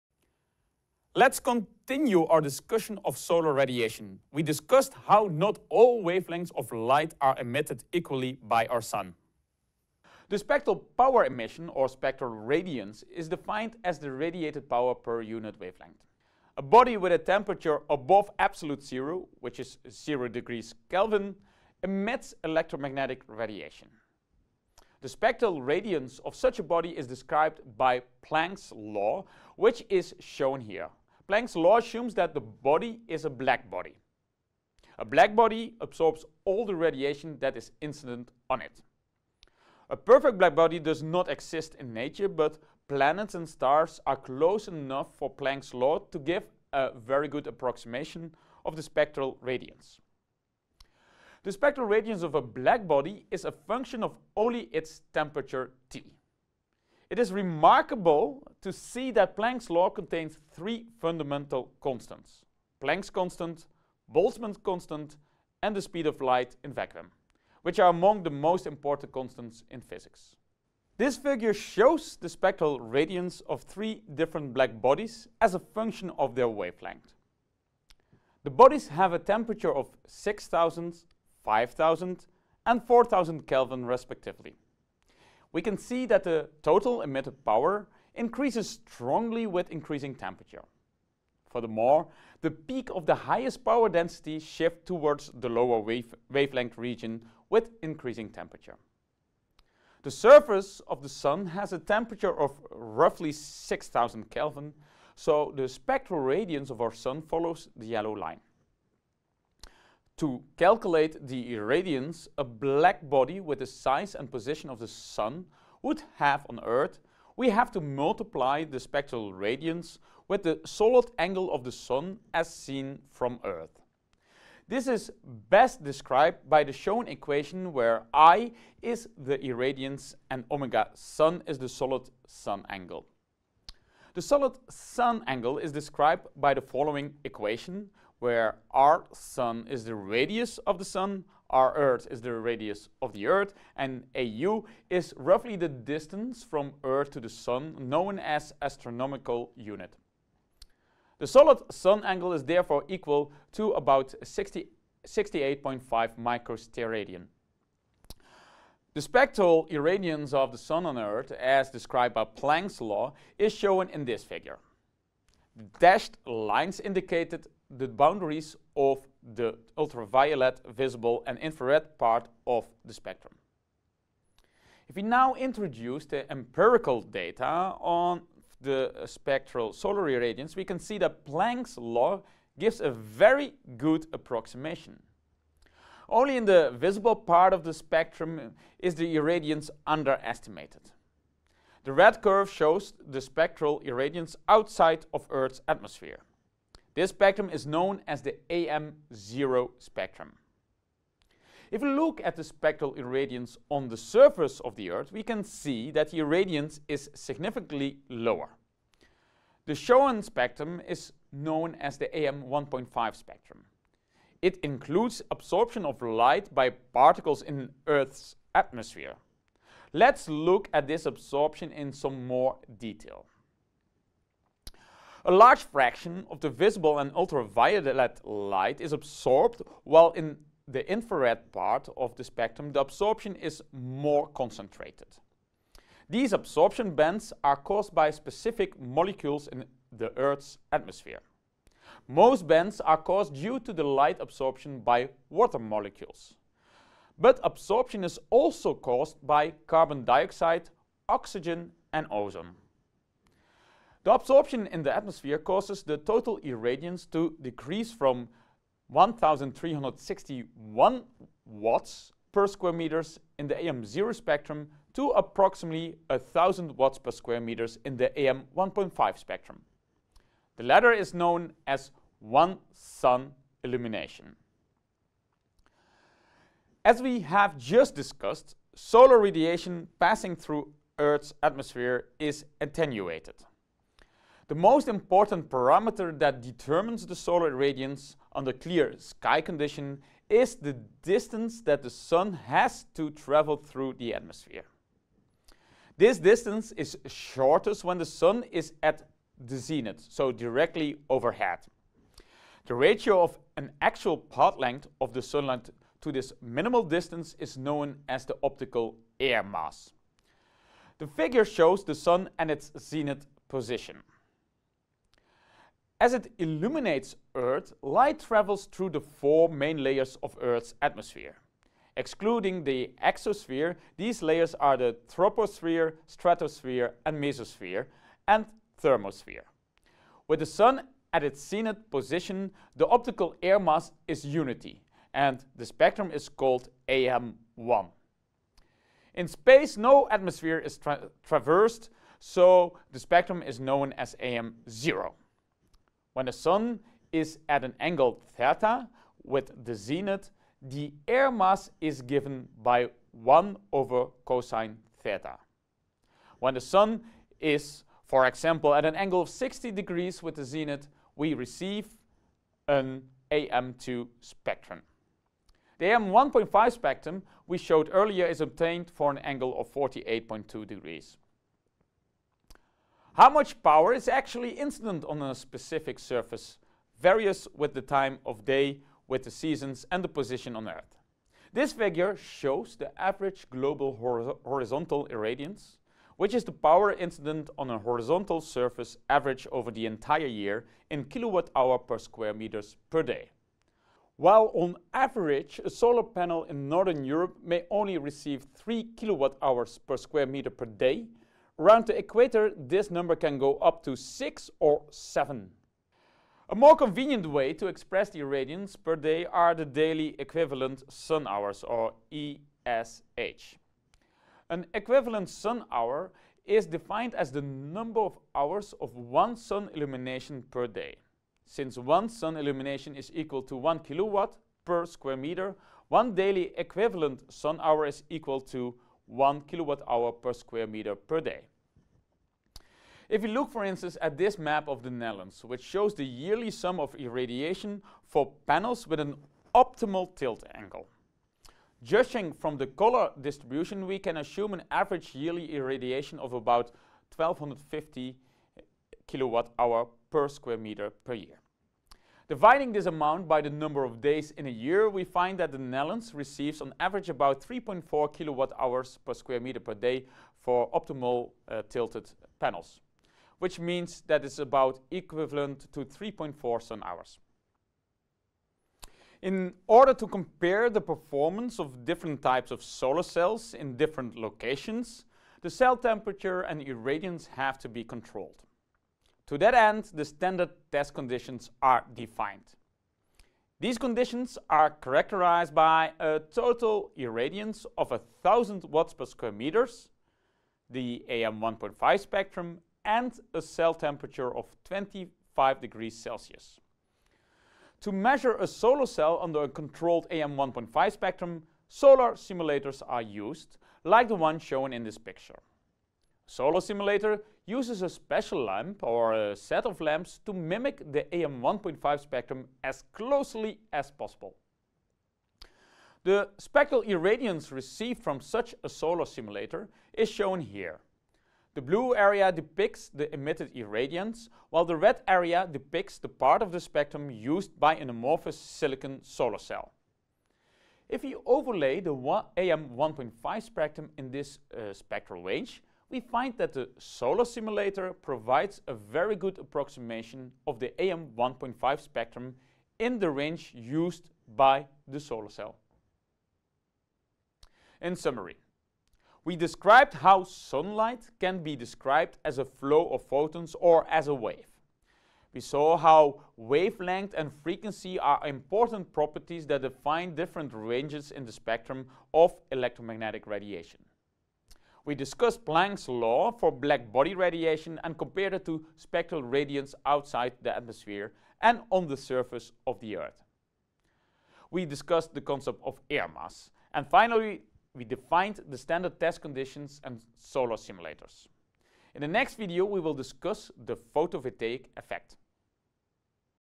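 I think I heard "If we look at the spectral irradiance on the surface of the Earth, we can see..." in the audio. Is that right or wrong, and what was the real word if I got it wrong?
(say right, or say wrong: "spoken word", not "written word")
right.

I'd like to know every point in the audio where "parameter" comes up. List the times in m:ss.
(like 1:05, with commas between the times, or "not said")
4:45.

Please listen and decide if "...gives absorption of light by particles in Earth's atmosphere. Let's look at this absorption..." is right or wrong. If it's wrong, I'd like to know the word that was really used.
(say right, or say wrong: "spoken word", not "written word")
wrong: "includes", not "gives".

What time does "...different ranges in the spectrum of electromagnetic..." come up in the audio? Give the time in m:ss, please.
9:20.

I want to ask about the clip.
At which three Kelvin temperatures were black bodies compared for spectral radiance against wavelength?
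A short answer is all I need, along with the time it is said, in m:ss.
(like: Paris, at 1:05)
6000, 5000 and 4000, at 1:20.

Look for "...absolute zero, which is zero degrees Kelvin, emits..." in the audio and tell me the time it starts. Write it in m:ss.
0:18.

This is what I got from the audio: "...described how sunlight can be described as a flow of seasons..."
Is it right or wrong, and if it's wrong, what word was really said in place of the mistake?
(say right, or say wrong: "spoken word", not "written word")
wrong: "photons", not "seasons".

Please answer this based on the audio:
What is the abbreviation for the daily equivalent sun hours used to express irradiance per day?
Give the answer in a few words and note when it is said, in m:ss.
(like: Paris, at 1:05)
ESH, at 6:52.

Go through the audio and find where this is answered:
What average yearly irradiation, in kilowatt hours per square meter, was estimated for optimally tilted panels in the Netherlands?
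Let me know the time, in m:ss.
7:27.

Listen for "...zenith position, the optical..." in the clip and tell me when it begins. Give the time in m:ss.
5:31.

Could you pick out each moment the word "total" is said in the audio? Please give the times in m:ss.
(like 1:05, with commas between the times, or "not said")
1:26, 4:15, 8:06.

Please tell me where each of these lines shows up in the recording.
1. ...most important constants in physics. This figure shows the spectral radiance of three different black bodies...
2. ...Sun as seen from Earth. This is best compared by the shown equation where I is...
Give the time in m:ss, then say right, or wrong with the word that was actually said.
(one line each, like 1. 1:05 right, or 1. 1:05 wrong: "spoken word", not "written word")
1. 1:08 right
2. 2:01 wrong: "described", not "compared".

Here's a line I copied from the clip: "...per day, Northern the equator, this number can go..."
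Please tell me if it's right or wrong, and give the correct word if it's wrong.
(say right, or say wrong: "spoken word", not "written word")
wrong: "Around", not "Northern".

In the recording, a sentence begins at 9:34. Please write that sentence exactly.
We discussed the concept of air mass.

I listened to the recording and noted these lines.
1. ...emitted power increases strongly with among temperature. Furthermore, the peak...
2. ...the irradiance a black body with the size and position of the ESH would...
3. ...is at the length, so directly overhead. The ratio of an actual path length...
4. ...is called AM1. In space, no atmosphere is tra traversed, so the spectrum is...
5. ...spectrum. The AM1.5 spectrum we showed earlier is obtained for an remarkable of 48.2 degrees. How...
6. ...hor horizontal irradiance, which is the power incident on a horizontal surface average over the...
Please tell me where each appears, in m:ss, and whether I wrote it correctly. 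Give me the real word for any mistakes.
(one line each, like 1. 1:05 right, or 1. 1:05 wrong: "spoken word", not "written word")
1. 1:27 wrong: "increasing", not "among"
2. 1:51 wrong: "Sun", not "ESH"
3. 4:58 wrong: "zenith", not "length"
4. 5:36 right
5. 6:04 wrong: "angle", not "remarkable"
6. 6:23 right.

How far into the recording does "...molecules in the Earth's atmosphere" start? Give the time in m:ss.
3:58.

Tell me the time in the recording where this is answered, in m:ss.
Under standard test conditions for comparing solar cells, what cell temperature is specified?
8:14.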